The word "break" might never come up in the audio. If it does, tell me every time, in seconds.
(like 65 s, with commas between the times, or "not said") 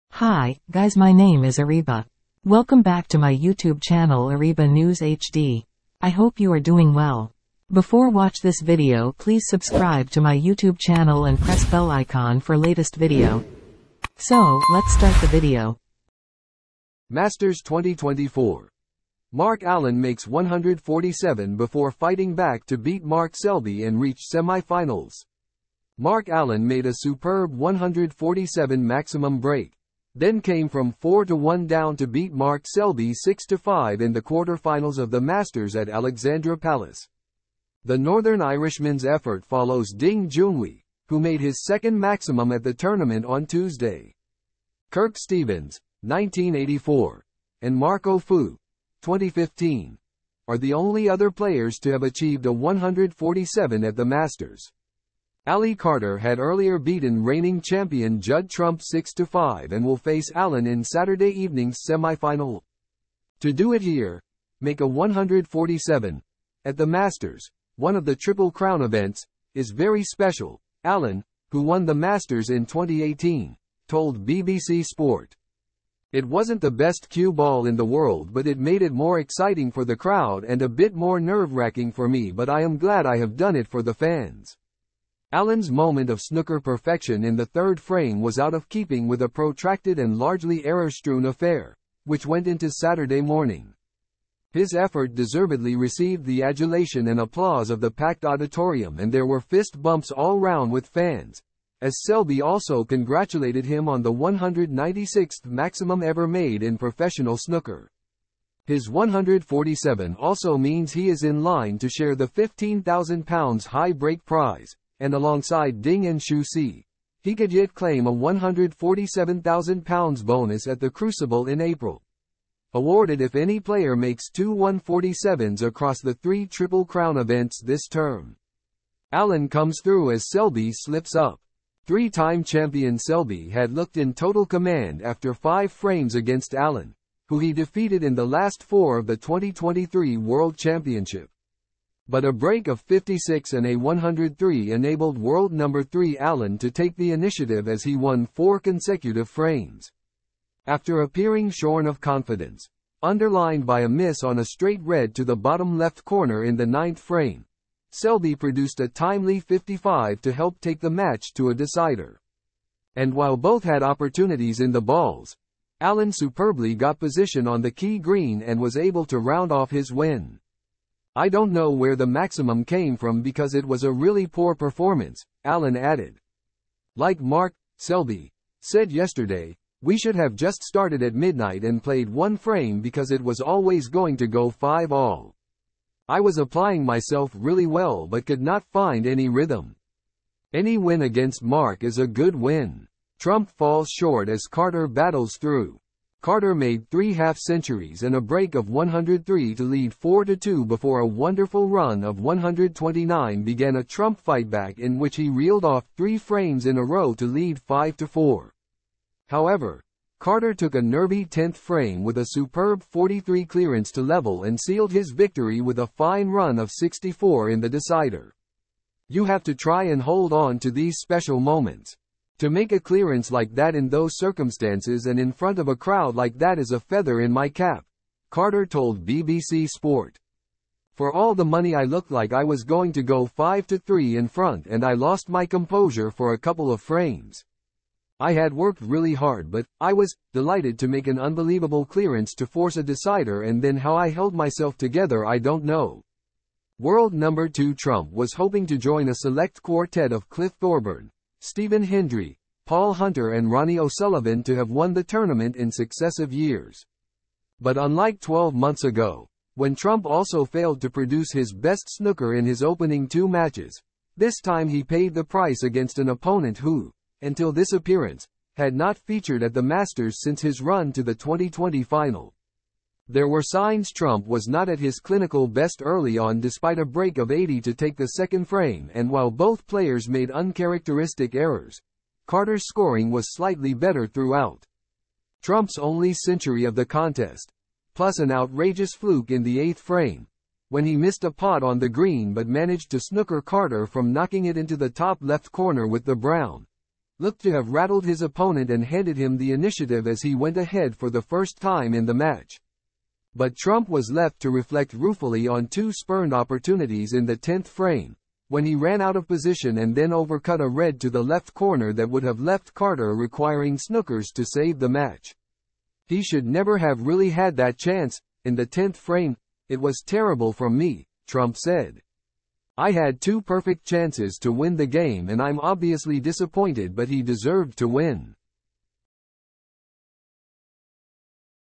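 29 s, 113 s, 142 s, 198 s, 276 s.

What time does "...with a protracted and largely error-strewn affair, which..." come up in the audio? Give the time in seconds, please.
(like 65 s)
89 s.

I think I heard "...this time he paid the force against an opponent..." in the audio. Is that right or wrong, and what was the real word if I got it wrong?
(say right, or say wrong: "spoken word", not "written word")
wrong: "price", not "force".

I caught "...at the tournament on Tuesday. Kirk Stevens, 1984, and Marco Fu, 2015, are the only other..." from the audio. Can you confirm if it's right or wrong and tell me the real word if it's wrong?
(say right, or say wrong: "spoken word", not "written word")
right.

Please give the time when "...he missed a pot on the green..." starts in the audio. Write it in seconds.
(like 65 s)
290 s.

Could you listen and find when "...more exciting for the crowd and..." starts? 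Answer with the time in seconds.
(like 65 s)
78 s.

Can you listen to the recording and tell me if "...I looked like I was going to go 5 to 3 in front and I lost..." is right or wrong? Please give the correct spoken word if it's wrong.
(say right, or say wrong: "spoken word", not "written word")
right.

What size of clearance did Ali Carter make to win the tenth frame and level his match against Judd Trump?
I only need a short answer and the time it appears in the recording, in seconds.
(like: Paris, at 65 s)
43, at 212 s.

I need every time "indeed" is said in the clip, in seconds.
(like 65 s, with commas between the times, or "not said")
not said.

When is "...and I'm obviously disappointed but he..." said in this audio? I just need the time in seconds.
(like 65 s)
325 s.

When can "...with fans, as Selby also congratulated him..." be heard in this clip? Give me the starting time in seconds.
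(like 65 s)
100 s.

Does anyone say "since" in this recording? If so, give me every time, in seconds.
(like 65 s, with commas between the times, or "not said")
270 s.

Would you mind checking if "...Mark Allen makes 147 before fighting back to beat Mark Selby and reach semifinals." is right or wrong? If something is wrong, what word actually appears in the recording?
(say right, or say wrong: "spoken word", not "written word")
right.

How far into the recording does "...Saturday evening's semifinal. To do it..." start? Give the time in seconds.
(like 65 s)
60 s.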